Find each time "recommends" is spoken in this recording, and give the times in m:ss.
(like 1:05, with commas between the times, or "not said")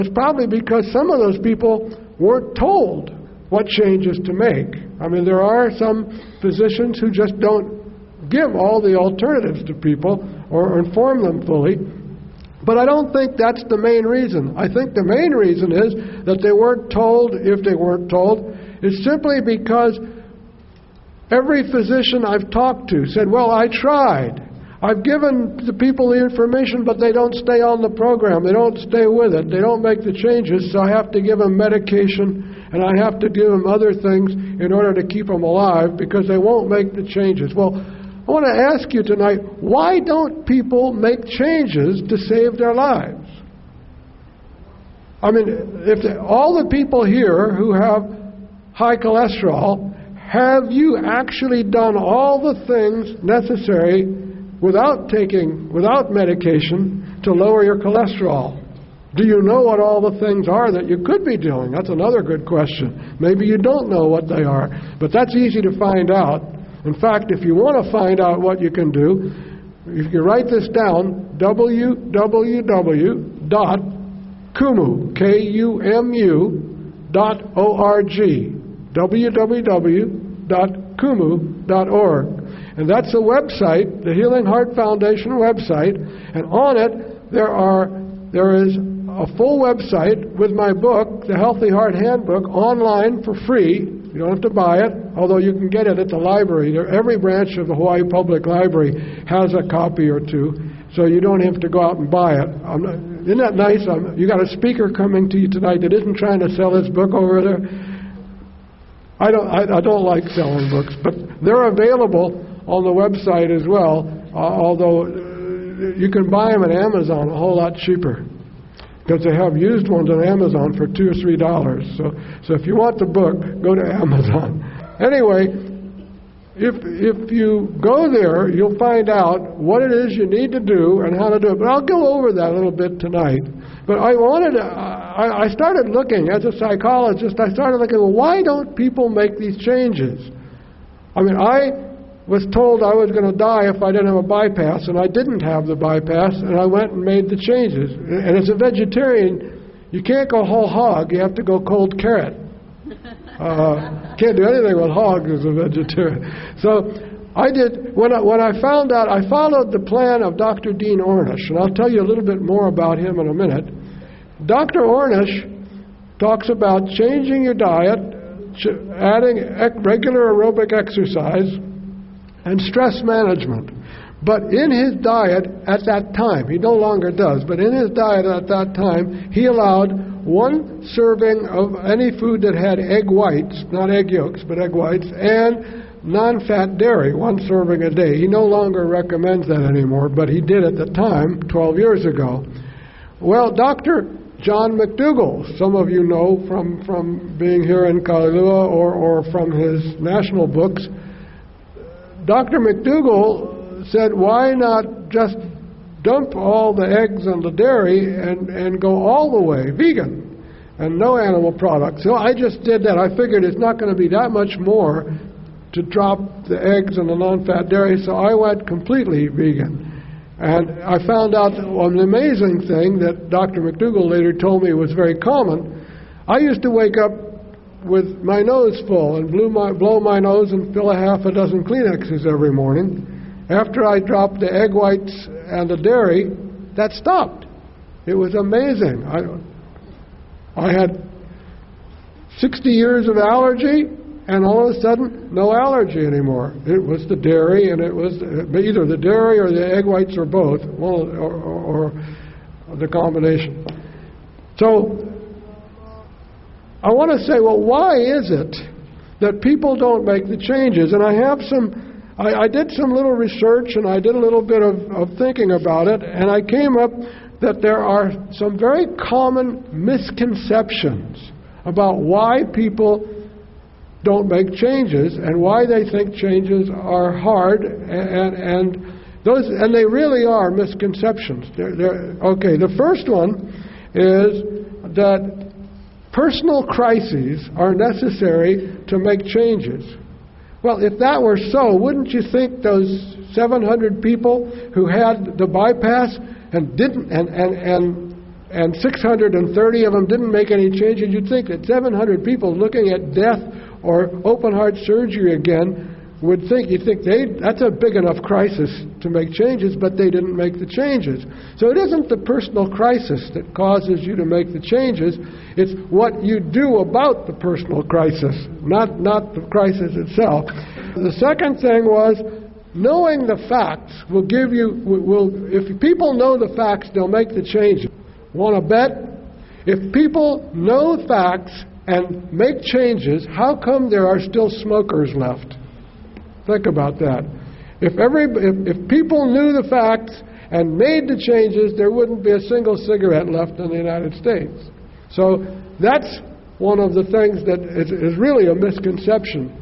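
3:08.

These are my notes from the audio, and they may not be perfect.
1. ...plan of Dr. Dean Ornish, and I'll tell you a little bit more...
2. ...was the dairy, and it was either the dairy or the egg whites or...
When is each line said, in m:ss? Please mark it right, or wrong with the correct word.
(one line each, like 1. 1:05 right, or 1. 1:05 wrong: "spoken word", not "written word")
1. 2:39 right
2. 4:06 right.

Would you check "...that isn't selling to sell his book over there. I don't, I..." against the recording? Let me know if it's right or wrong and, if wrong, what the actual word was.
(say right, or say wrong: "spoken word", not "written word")
wrong: "trying", not "selling".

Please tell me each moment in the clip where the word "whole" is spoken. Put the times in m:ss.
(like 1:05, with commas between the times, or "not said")
1:57, 2:30.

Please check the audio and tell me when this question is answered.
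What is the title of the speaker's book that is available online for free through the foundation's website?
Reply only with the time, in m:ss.
1:31.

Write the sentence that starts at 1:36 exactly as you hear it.
Every branch of the Hawaii Public Library has a copy or two, so you don't have to go out and buy it.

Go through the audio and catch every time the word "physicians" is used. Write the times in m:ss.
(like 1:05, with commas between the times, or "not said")
0:06, 0:21.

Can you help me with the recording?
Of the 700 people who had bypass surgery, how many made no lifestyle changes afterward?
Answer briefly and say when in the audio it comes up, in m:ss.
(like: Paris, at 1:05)
630, at 4:58.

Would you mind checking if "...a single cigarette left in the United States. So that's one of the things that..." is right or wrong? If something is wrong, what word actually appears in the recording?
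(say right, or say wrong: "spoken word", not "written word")
right.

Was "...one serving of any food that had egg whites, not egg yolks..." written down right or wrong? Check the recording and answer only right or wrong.
right.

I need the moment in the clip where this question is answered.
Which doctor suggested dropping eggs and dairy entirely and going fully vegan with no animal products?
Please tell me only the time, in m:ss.
3:13.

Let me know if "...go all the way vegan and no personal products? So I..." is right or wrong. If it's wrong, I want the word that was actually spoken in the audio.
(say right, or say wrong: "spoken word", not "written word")
wrong: "animal", not "personal".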